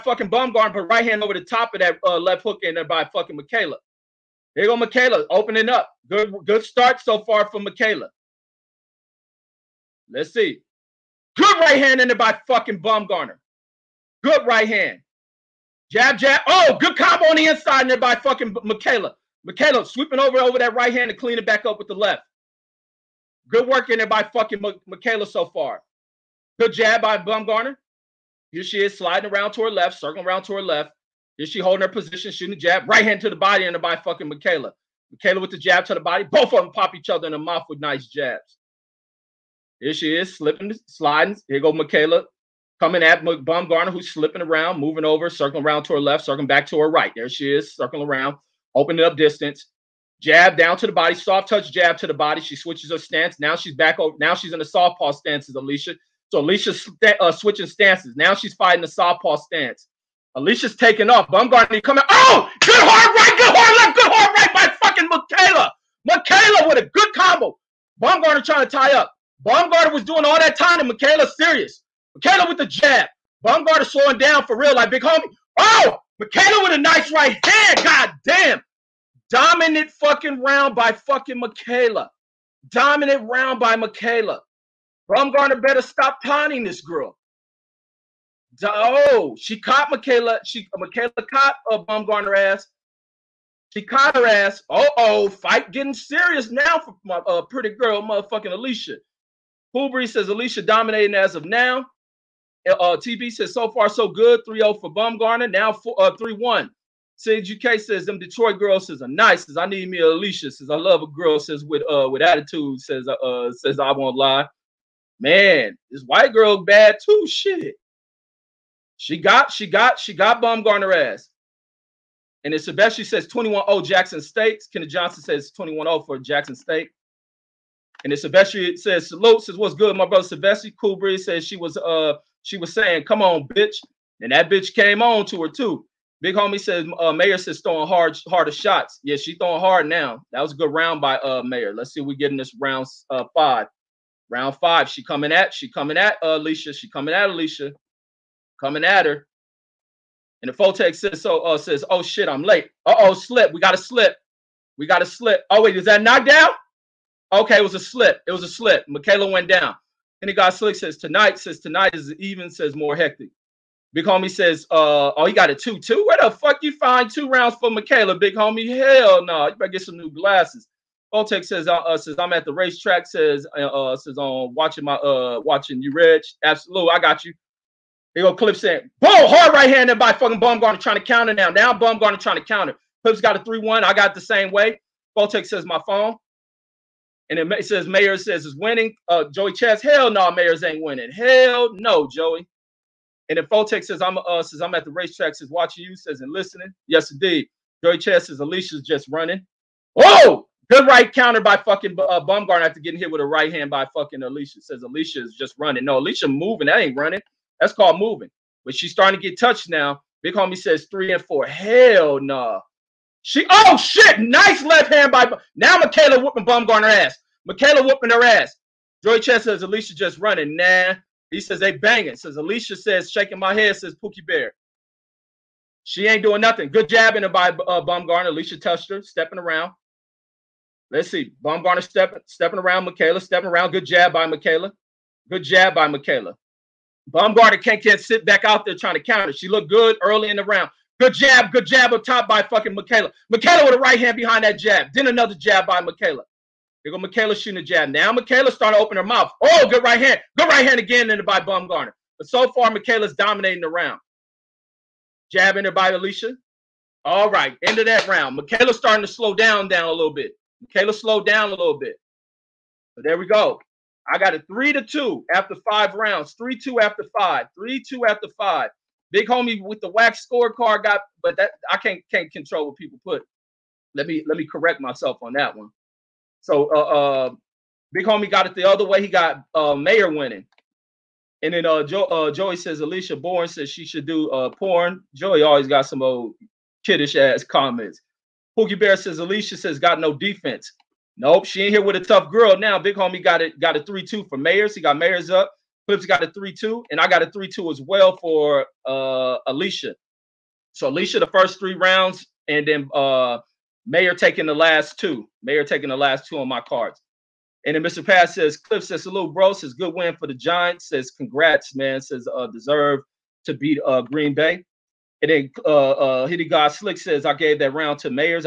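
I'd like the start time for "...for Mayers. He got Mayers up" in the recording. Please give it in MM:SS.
04:54.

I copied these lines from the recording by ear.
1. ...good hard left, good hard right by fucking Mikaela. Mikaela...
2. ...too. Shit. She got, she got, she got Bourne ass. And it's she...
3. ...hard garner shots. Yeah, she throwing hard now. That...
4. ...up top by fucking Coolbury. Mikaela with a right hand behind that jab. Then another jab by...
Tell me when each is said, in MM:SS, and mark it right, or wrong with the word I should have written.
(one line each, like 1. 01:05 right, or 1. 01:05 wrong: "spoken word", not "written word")
1. 01:03 right
2. 01:57 wrong: "Baumgardner", not "Bourne"
3. 02:17 wrong: "harder", not "garner"
4. 04:01 wrong: "Mikaela", not "Coolbury".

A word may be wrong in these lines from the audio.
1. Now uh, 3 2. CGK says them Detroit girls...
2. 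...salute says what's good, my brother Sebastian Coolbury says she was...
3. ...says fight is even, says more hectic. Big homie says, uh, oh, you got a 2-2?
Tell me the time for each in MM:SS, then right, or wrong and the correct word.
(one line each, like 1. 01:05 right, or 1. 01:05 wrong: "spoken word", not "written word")
1. 01:45 wrong: "1", not "2"
2. 02:09 right
3. 02:41 wrong: "tonight", not "fight".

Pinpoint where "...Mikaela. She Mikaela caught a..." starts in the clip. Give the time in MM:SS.
01:29.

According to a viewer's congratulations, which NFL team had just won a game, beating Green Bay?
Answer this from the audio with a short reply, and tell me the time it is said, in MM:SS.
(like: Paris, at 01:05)
Giants, at 05:10.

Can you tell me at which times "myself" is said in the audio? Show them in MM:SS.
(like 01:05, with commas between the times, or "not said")
04:34.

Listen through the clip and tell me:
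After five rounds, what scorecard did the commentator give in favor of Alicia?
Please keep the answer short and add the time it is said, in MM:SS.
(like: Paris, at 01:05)
3-2, at 04:24.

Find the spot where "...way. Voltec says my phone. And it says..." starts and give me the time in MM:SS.
03:04.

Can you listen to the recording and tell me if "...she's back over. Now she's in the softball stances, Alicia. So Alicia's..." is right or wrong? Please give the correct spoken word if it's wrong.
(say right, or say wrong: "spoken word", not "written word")
right.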